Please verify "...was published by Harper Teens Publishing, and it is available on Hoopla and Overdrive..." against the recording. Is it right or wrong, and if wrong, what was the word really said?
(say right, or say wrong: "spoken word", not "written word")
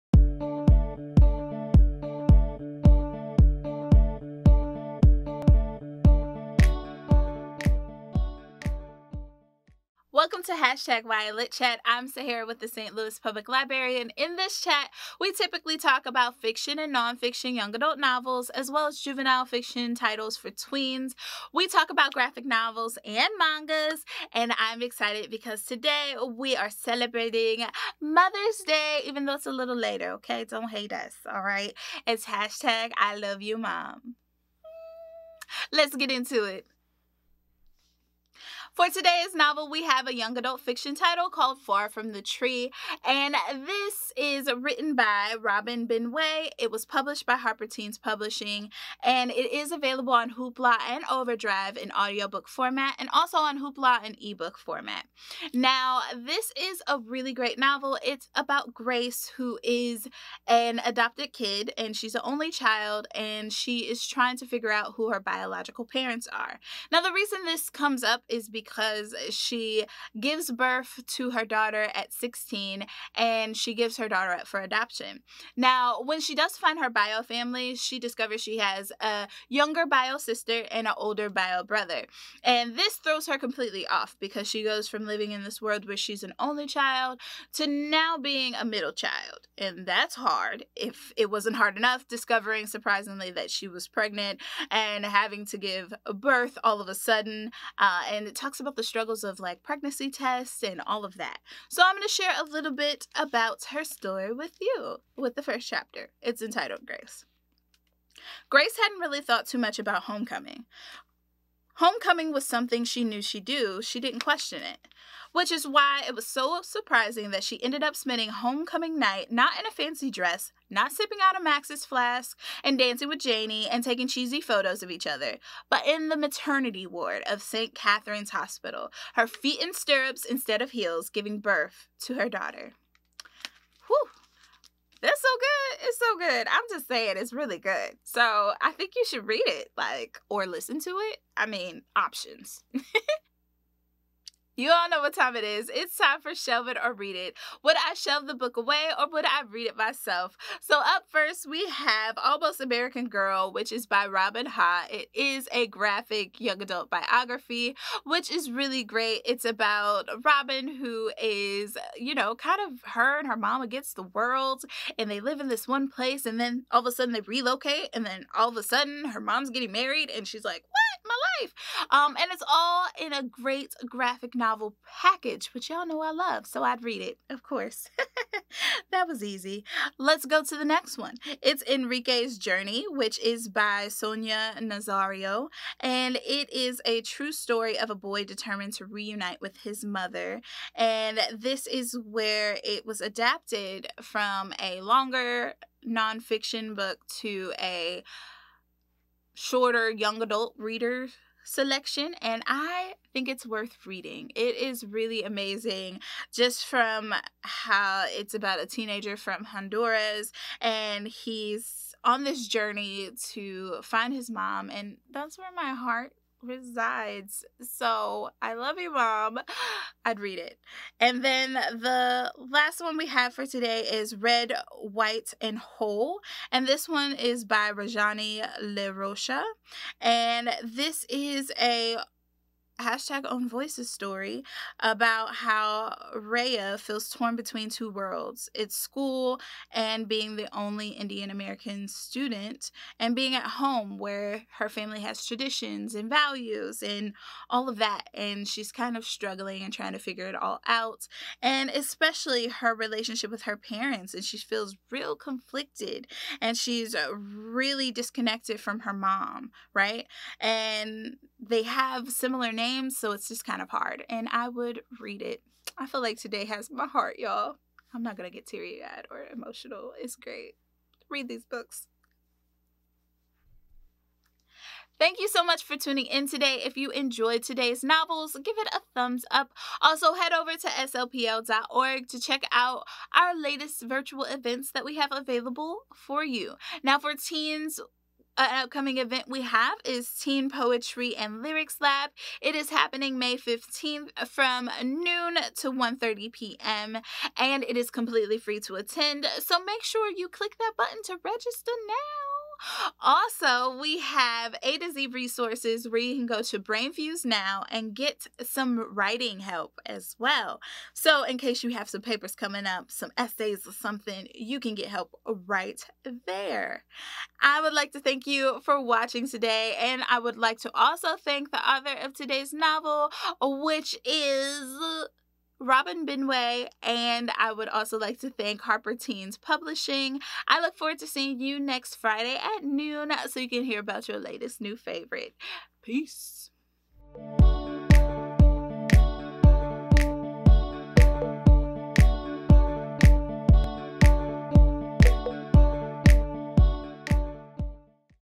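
right.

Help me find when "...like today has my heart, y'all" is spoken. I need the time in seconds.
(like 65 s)
266 s.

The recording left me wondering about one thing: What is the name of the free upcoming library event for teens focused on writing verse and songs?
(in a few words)
Teen Poetry and Lyrics Lab.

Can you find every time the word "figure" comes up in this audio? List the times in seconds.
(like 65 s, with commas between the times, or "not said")
64 s, 249 s.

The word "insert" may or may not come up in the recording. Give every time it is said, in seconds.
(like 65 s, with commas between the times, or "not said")
not said.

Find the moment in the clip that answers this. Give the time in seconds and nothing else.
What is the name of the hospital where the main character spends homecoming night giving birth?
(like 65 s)
127 s.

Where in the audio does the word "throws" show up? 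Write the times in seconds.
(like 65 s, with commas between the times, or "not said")
82 s.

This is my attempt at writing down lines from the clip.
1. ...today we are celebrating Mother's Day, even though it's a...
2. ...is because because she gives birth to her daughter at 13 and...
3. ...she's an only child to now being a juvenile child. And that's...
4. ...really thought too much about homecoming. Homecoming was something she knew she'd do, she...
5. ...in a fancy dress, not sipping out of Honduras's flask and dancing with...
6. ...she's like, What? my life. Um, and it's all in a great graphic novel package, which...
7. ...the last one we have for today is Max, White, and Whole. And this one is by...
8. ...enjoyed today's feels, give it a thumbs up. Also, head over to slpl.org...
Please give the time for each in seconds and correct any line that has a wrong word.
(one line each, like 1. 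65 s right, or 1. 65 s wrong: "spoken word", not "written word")
1. 25 s right
2. 68 s wrong: "16", not "13"
3. 85 s wrong: "middle", not "juvenile"
4. 108 s right
5. 119 s wrong: "Max", not "Honduras"
6. 170 s right
7. 221 s wrong: "Red", not "Max"
8. 276 s wrong: "novels", not "feels".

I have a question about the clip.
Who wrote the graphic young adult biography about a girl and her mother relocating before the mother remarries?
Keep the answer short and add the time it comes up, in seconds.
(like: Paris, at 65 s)
Robin Ha, at 154 s.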